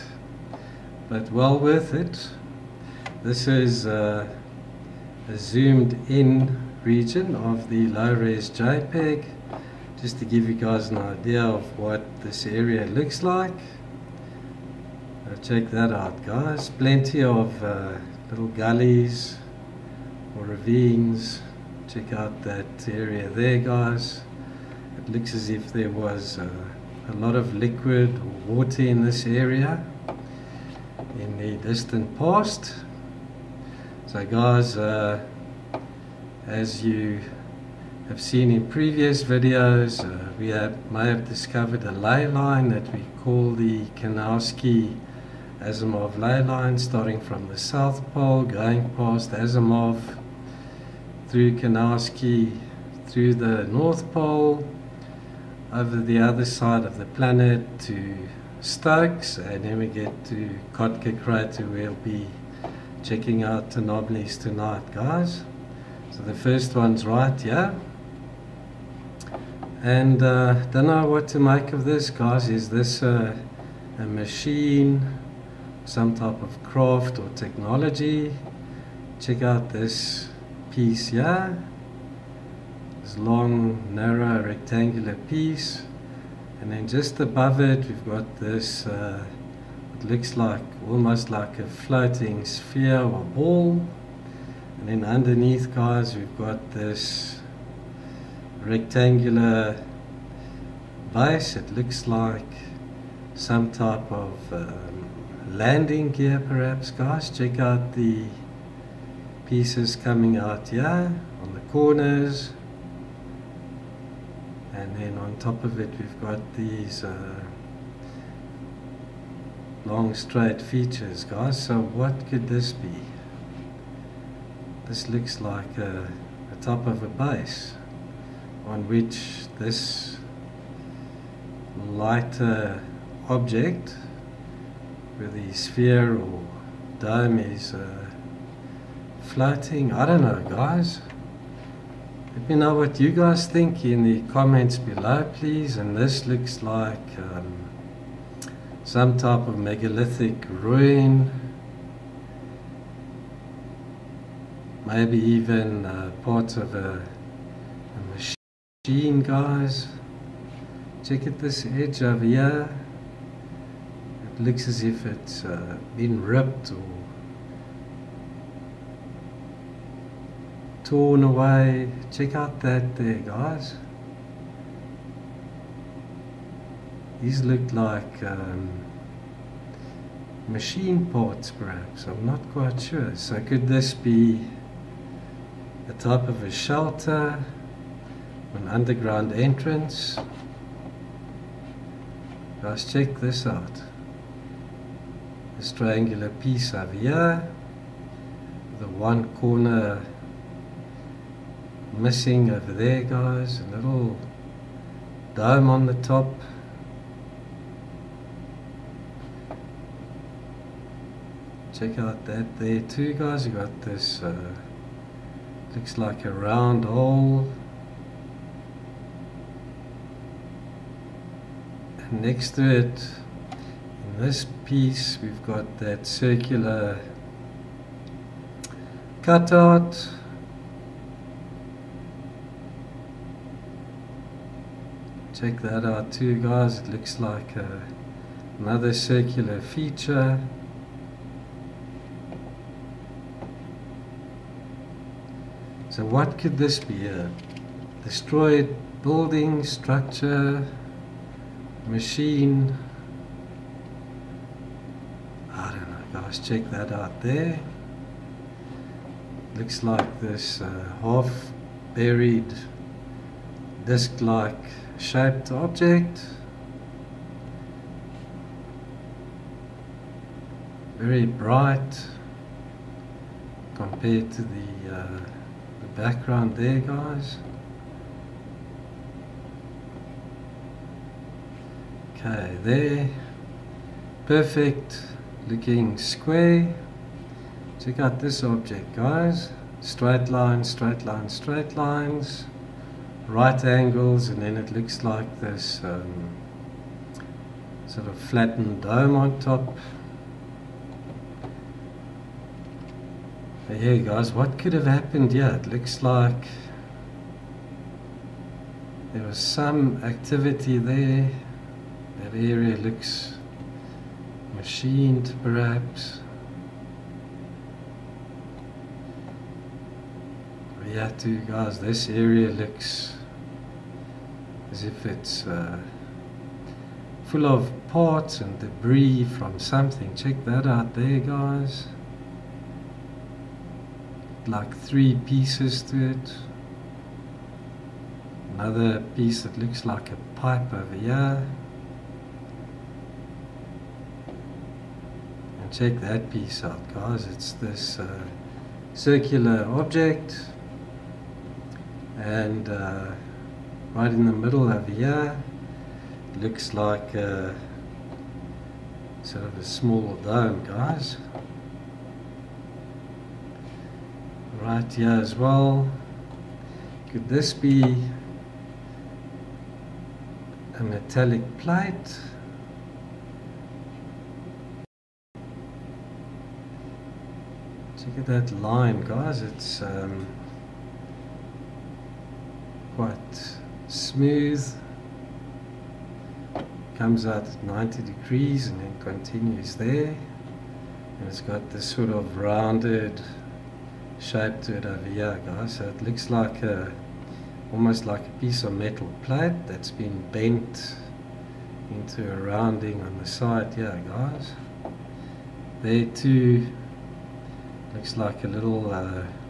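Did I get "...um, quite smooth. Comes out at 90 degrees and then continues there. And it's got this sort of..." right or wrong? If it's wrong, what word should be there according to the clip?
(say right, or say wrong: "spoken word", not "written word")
right.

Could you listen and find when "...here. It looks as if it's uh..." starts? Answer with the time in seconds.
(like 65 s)
162 s.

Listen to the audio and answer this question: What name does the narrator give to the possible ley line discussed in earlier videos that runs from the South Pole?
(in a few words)
Kunowsky Asimov ley line.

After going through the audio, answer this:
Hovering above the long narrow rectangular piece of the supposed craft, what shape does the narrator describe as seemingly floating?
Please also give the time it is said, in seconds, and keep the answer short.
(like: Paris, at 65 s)
sphere or ball, at 91 s.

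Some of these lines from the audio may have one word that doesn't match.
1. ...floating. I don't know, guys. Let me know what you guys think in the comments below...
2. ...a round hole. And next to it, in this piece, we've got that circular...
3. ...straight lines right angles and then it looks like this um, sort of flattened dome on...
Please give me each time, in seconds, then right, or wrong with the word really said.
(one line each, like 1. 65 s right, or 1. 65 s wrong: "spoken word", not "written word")
1. 139 s right
2. 216 s right
3. 291 s right.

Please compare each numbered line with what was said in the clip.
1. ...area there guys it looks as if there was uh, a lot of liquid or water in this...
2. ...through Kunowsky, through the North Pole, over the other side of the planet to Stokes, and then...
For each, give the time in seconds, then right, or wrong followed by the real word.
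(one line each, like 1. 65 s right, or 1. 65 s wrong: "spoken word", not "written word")
1. 22 s right
2. 51 s right.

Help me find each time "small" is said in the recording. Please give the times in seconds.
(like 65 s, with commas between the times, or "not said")
359 s.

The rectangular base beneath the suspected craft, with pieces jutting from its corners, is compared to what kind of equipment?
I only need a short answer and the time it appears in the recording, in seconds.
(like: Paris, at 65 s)
landing gear, at 105 s.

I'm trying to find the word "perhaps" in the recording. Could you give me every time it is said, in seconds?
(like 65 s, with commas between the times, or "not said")
106 s, 181 s, 315 s.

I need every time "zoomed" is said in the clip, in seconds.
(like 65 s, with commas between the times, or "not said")
5 s.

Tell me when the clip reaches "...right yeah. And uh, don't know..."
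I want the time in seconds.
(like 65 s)
67 s.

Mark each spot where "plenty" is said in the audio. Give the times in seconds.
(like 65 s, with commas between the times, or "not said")
16 s.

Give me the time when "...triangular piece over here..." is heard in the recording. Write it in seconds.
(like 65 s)
195 s.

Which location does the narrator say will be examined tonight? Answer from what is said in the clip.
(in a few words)
Tenoblis.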